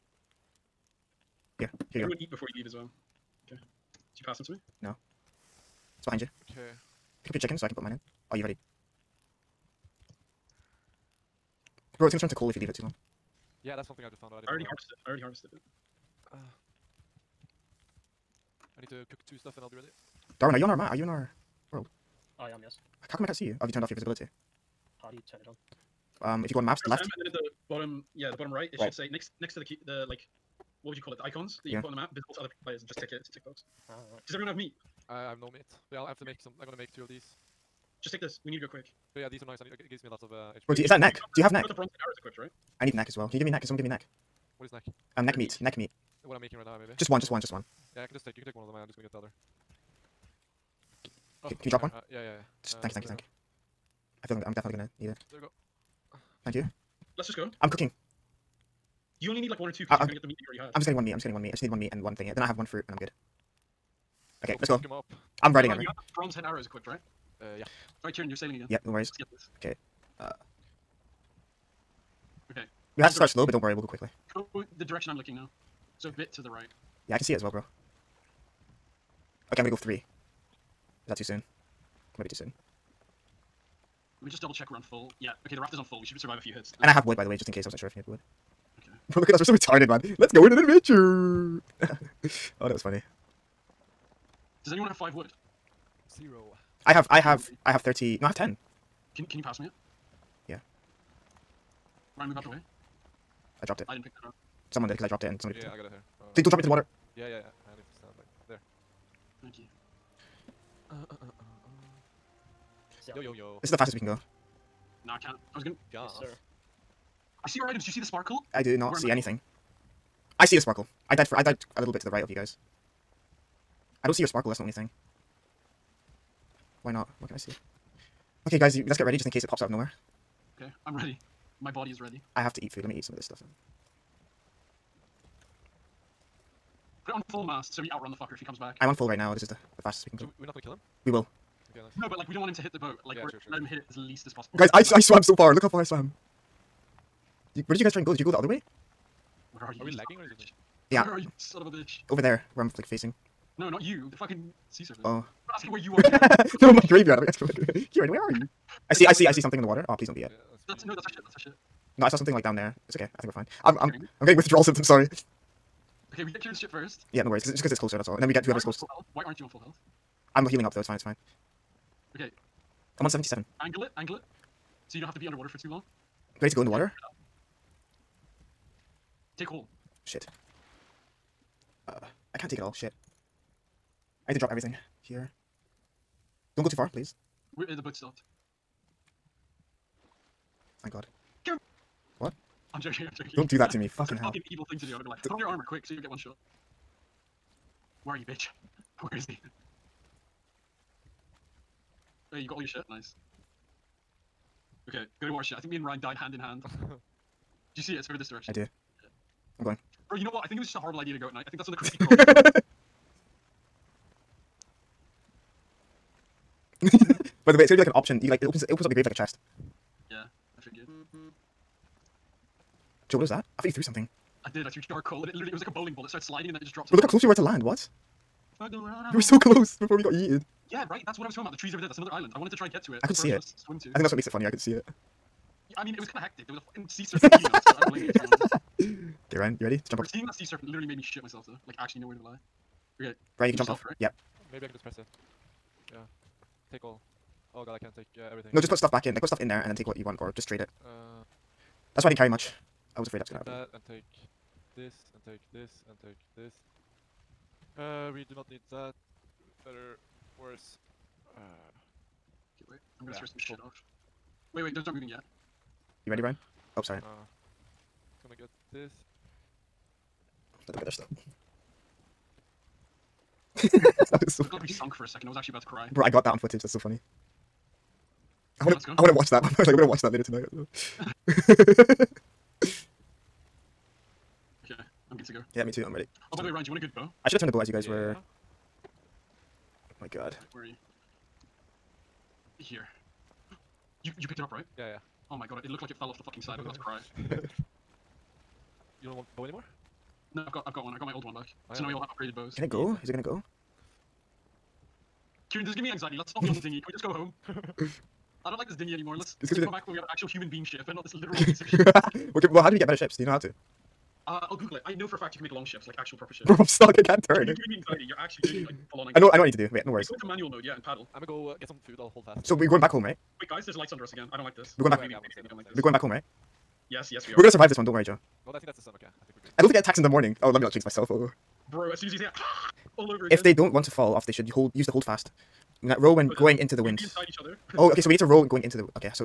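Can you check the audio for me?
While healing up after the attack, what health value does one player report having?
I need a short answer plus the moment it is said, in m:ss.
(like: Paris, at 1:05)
77, at 2:52.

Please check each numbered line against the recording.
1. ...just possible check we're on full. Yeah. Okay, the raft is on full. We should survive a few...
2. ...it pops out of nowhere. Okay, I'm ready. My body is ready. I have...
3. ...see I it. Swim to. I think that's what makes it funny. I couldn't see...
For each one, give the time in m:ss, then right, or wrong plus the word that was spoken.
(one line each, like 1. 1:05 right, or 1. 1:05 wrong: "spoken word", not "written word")
1. 1:24 wrong: "double", not "possible"
2. 2:09 right
3. 3:53 right.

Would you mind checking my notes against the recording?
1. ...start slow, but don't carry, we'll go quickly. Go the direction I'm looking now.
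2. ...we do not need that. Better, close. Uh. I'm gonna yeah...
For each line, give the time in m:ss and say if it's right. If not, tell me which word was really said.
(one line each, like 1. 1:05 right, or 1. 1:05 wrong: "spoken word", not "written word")
1. 1:13 wrong: "worry", not "carry"
2. 4:18 wrong: "worse", not "close".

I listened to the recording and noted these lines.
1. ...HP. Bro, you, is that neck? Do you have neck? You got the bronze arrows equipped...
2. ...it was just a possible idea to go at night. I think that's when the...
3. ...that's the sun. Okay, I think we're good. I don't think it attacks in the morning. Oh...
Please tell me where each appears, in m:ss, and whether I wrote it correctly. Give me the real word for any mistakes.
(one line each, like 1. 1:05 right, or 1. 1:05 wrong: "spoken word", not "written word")
1. 0:40 right
2. 3:30 wrong: "horrible", not "possible"
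3. 5:28 right.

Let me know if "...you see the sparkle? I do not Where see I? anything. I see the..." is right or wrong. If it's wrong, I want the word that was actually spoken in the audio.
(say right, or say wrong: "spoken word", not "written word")
right.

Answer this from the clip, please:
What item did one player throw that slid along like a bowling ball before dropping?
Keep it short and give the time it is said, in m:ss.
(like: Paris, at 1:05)
charcoal, at 3:44.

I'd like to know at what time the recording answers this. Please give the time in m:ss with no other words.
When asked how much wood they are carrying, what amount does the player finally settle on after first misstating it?
1:38.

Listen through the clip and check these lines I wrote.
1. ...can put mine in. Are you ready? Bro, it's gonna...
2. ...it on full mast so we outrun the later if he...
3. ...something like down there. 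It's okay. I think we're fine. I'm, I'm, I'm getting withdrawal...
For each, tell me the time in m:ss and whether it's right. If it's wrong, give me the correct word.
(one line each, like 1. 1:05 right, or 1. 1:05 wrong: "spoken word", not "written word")
1. 0:07 right
2. 2:17 wrong: "fucker", not "later"
3. 2:42 right.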